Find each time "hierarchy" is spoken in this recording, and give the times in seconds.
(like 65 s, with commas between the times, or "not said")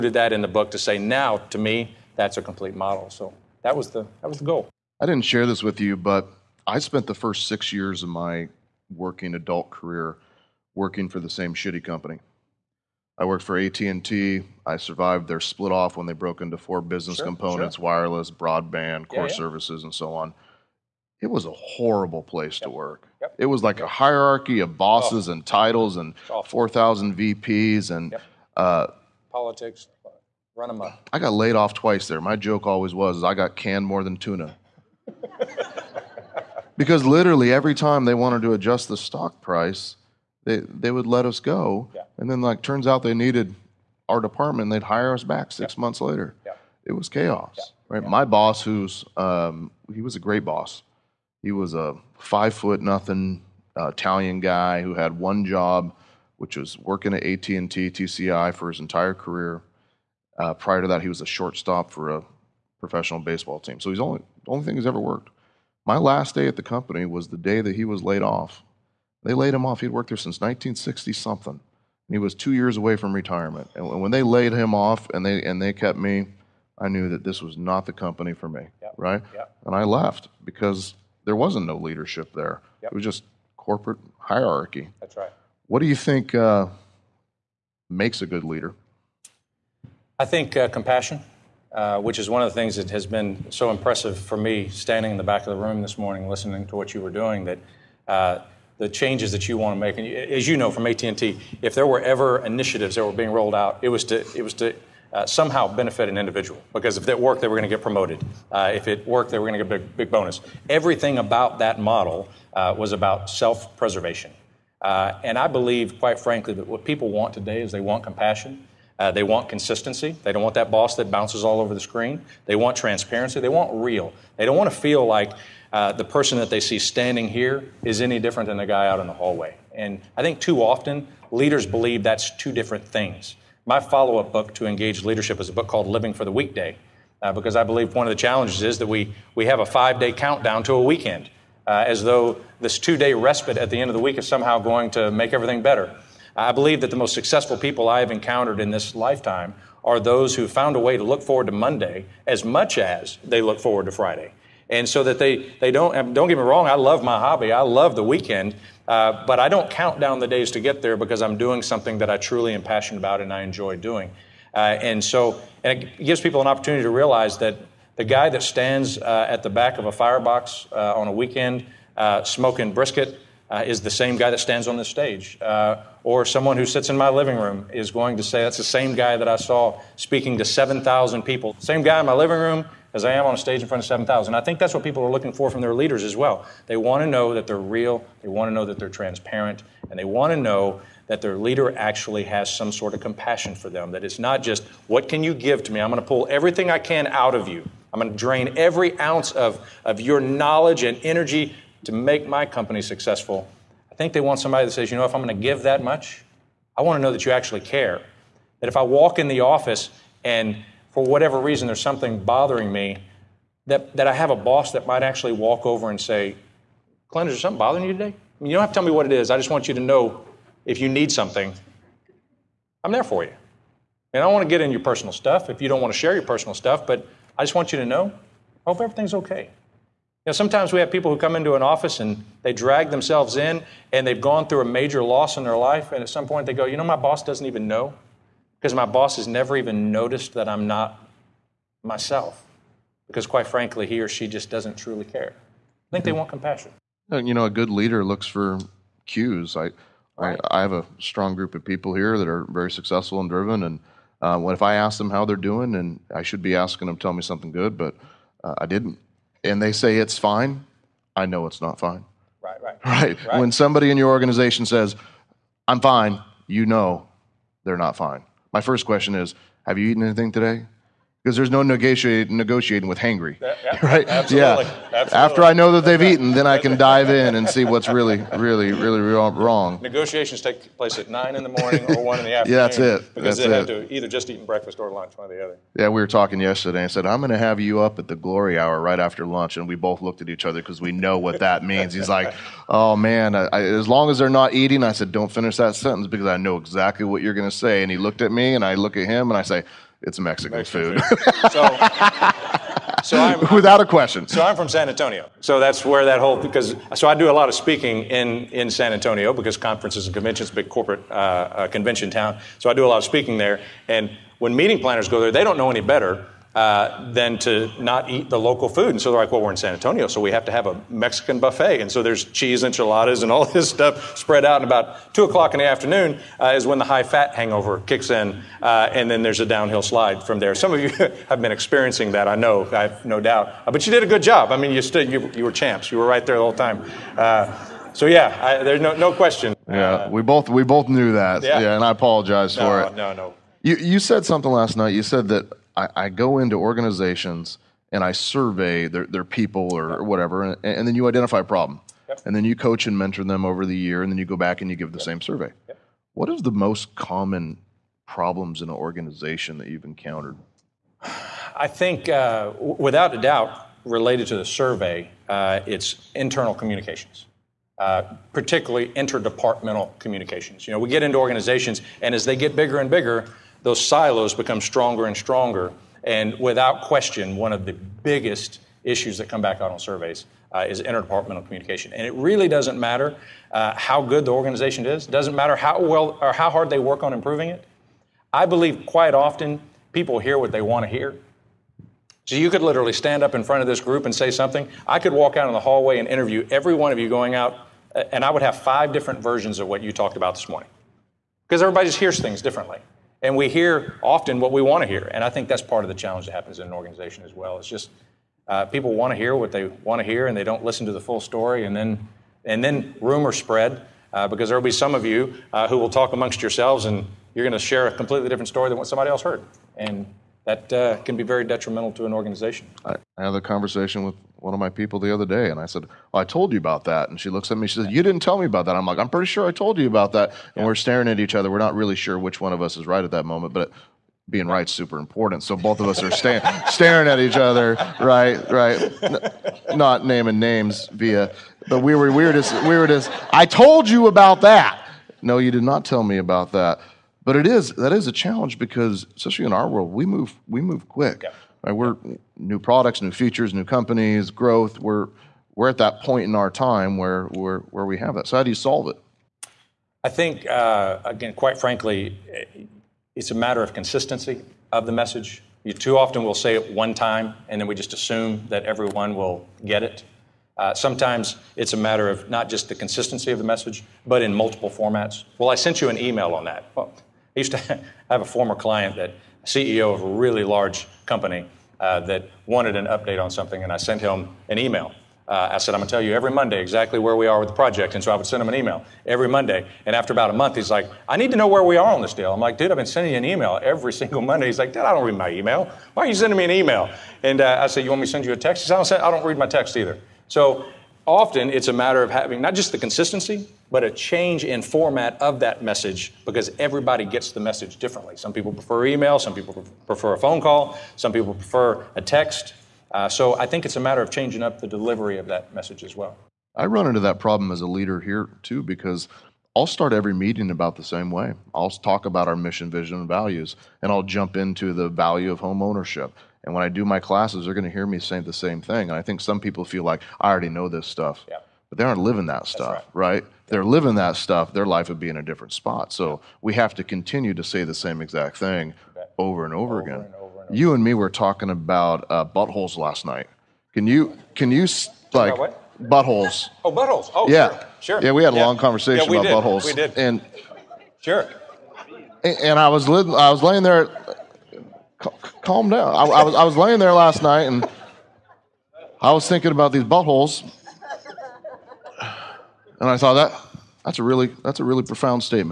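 23 s, 84 s.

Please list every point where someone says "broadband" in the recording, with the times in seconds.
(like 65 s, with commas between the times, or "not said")
18 s.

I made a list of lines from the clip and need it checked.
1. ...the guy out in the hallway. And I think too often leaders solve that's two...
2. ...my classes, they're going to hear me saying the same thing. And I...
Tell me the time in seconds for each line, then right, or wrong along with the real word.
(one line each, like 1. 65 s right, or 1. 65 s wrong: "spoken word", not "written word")
1. 128 s wrong: "believe", not "solve"
2. 526 s right.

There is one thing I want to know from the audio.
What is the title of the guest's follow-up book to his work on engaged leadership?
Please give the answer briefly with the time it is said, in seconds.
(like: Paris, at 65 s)
Living for the Weekday, at 135 s.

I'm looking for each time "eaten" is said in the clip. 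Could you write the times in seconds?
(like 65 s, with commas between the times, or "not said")
269 s, 276 s.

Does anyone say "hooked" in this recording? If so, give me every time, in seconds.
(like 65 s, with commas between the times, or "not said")
not said.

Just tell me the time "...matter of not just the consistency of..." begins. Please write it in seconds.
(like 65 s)
471 s.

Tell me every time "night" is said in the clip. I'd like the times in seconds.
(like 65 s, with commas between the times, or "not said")
344 s, 543 s, 557 s.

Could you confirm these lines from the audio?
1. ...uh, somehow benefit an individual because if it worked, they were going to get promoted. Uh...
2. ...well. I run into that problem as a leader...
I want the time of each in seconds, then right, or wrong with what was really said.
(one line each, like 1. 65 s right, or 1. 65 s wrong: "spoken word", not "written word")
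1. 105 s right
2. 515 s right.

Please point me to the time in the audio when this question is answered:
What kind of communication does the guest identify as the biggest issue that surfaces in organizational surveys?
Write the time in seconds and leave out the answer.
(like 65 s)
368 s.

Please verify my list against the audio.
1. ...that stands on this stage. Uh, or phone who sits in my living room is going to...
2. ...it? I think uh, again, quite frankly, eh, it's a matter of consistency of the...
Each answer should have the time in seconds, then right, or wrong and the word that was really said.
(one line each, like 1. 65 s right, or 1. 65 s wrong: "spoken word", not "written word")
1. 174 s wrong: "someone", not "phone"
2. 458 s right.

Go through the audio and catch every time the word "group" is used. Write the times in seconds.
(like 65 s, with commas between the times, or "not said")
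251 s, 393 s.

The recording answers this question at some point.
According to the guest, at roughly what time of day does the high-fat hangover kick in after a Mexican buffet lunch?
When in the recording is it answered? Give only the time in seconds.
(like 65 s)
325 s.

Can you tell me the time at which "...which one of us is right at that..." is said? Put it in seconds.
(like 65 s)
432 s.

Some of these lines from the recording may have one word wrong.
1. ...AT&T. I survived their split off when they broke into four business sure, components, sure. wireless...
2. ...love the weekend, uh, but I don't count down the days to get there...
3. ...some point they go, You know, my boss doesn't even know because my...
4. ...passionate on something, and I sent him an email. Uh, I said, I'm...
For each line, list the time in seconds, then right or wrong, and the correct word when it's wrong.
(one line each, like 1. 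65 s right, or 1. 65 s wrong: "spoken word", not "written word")
1. 13 s right
2. 157 s right
3. 236 s right
4. 482 s wrong: "update", not "passionate".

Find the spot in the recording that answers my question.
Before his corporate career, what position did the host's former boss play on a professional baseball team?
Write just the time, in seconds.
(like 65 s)
61 s.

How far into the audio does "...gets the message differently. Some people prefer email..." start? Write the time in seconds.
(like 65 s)
507 s.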